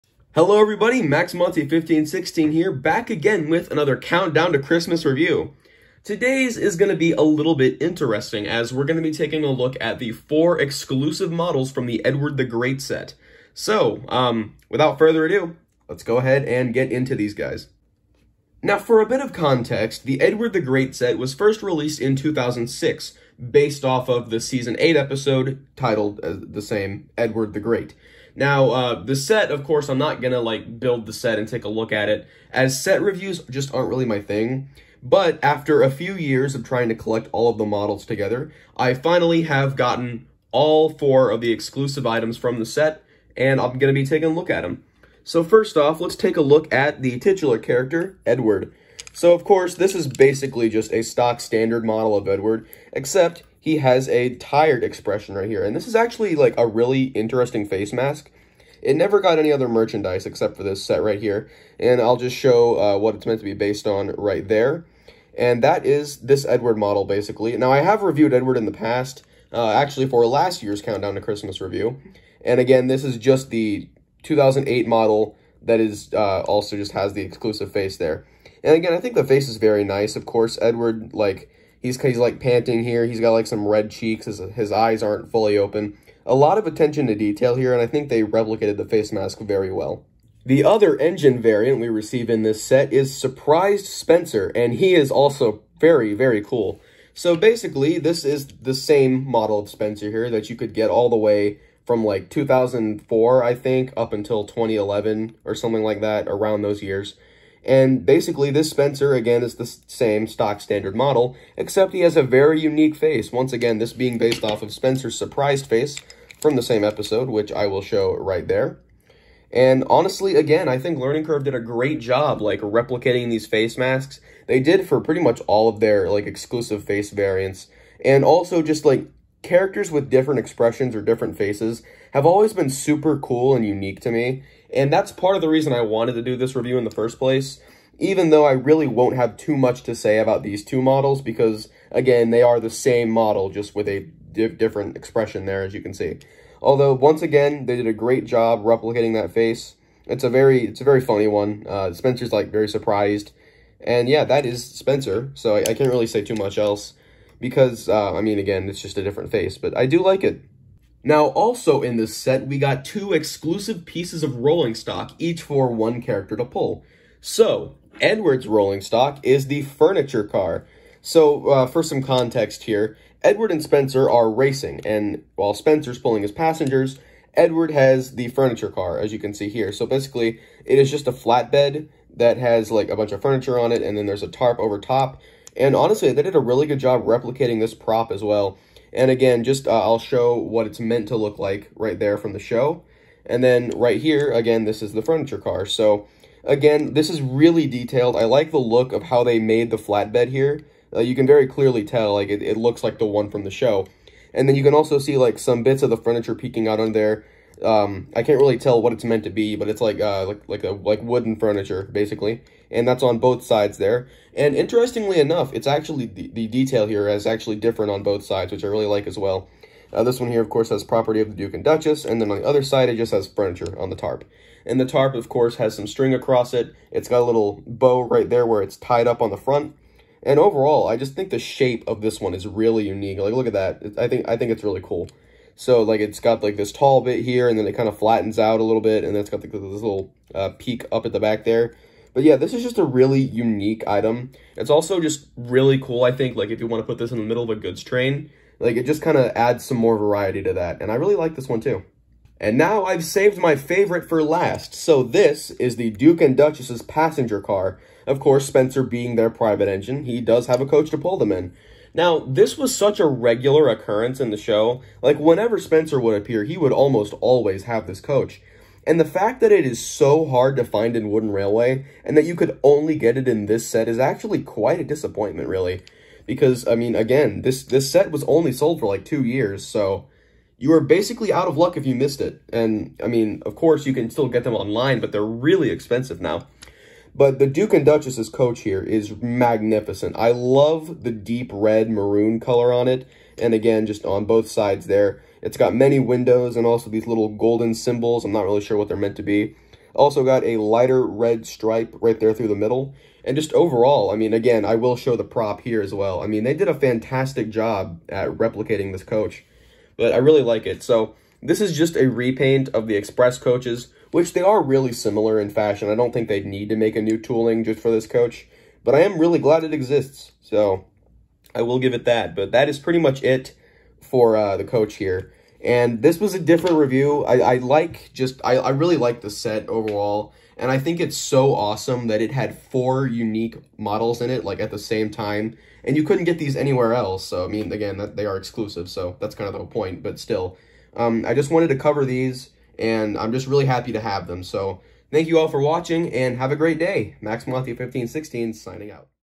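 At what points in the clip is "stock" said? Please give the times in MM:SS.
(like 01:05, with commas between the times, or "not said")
00:51, 01:50, 02:44, 02:48.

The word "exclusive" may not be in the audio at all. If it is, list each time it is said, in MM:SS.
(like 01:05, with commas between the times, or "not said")
00:10, 00:41, 01:17, 02:06, 02:43, 05:38.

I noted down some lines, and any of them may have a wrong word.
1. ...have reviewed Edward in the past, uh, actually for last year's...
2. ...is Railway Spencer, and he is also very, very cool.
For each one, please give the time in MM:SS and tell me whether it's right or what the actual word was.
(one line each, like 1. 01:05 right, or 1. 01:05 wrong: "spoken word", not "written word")
1. 01:07 right
2. 01:32 wrong: "Surprised", not "Railway".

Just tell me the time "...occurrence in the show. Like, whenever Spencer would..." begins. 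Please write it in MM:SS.
04:23.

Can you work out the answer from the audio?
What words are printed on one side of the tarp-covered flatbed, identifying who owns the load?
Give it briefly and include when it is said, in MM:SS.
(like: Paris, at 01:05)
property of the Duke and Duchess, at 03:40.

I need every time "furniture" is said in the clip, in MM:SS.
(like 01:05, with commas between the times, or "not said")
02:49, 02:58, 03:03, 03:15, 03:25, 03:31, 03:43.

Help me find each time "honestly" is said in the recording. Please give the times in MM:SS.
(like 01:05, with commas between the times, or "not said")
01:59, 03:05.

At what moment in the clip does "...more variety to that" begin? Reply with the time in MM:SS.
04:09.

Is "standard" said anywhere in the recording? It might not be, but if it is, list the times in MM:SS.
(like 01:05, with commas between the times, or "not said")
00:51, 01:50.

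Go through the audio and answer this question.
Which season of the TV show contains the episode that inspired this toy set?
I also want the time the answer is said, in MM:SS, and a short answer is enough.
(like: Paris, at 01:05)
Season 8, at 00:24.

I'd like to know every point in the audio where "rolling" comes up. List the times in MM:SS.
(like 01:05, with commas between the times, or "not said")
02:44, 02:48.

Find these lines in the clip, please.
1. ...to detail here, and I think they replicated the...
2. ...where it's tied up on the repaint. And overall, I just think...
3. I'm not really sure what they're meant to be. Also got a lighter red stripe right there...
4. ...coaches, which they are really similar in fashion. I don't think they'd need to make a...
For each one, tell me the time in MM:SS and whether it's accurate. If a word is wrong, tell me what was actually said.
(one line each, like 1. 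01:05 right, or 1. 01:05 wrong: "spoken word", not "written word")
1. 01:27 right
2. 03:48 wrong: "front", not "repaint"
3. 04:58 right
4. 05:13 right.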